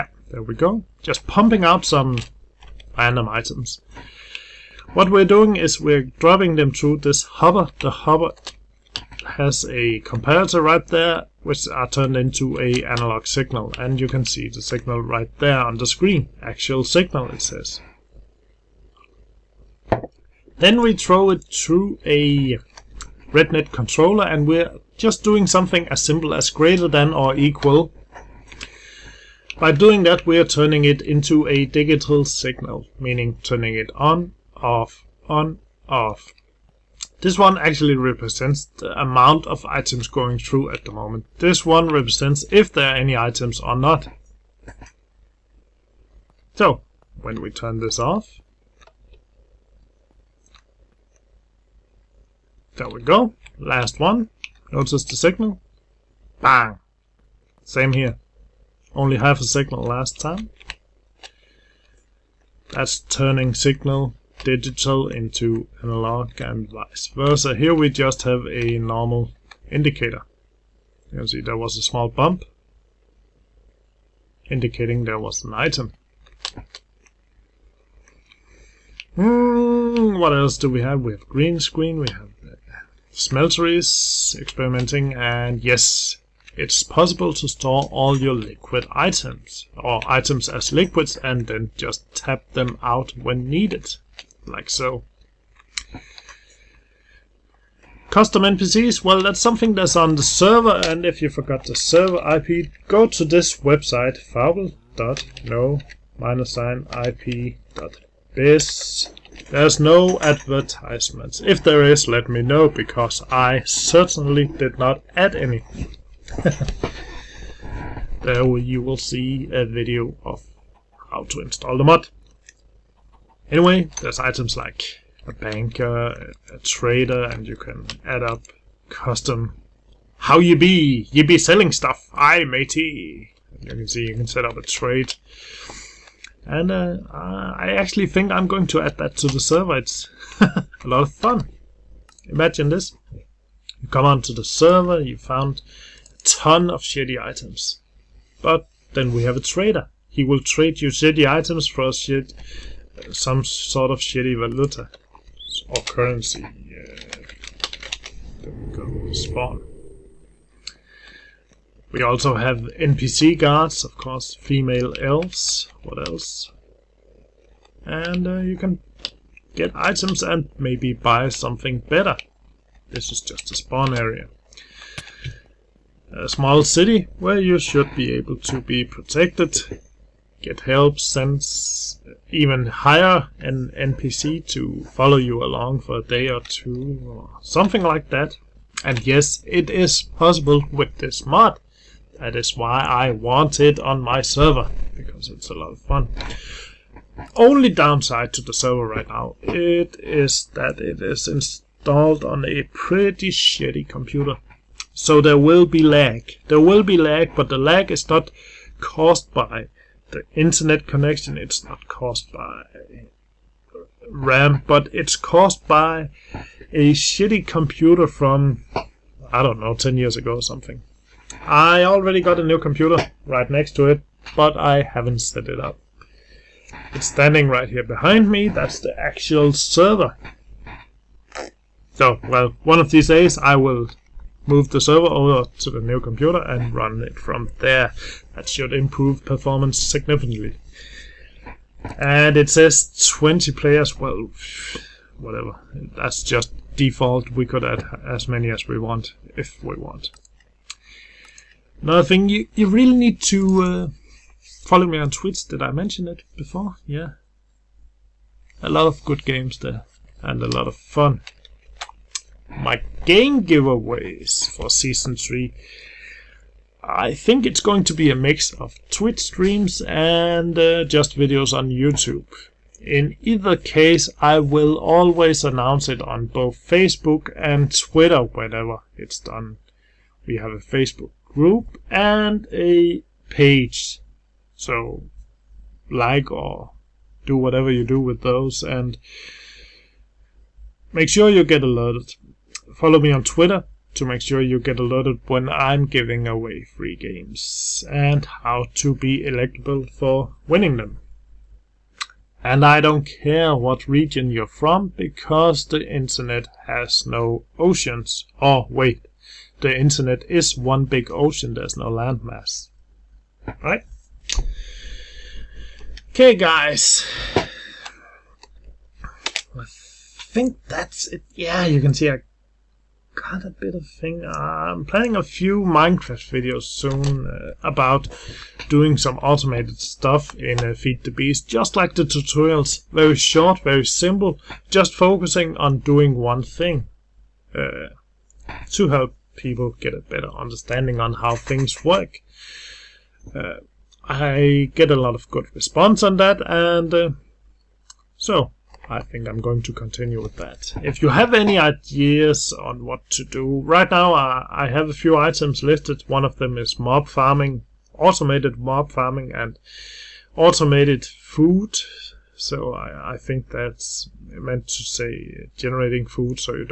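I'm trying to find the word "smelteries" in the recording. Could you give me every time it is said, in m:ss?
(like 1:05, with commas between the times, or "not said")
1:23.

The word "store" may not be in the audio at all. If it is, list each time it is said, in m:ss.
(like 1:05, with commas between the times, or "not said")
1:27.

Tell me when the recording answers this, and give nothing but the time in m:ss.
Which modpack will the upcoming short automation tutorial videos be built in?
5:30.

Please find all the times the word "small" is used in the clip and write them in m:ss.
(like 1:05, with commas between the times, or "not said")
1:11, 2:56.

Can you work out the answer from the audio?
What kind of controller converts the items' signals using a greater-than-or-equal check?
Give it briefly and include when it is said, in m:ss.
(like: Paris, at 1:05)
RedNet controller, at 0:23.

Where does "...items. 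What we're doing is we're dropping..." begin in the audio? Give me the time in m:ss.
0:03.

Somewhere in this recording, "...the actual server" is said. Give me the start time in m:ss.
3:48.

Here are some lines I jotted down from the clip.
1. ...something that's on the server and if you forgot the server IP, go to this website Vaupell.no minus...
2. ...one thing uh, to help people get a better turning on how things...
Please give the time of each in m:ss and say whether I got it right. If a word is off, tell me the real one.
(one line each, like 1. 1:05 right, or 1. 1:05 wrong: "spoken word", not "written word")
1. 1:39 right
2. 5:36 wrong: "understanding", not "turning".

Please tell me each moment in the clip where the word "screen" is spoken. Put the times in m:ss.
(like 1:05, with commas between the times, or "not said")
0:15, 1:21.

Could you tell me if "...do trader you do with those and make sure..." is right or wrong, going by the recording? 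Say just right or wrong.
wrong.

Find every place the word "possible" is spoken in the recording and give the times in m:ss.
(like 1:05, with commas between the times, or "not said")
1:26, 3:10.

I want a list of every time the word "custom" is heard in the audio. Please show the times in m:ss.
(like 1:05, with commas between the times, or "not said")
1:38, 2:08.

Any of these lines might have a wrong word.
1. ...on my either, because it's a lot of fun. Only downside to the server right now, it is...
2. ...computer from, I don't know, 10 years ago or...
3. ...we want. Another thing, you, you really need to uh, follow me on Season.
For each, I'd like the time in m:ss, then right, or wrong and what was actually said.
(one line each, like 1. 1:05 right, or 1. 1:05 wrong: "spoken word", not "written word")
1. 3:13 wrong: "server", not "either"
2. 3:37 right
3. 4:09 wrong: "Twitch", not "Season".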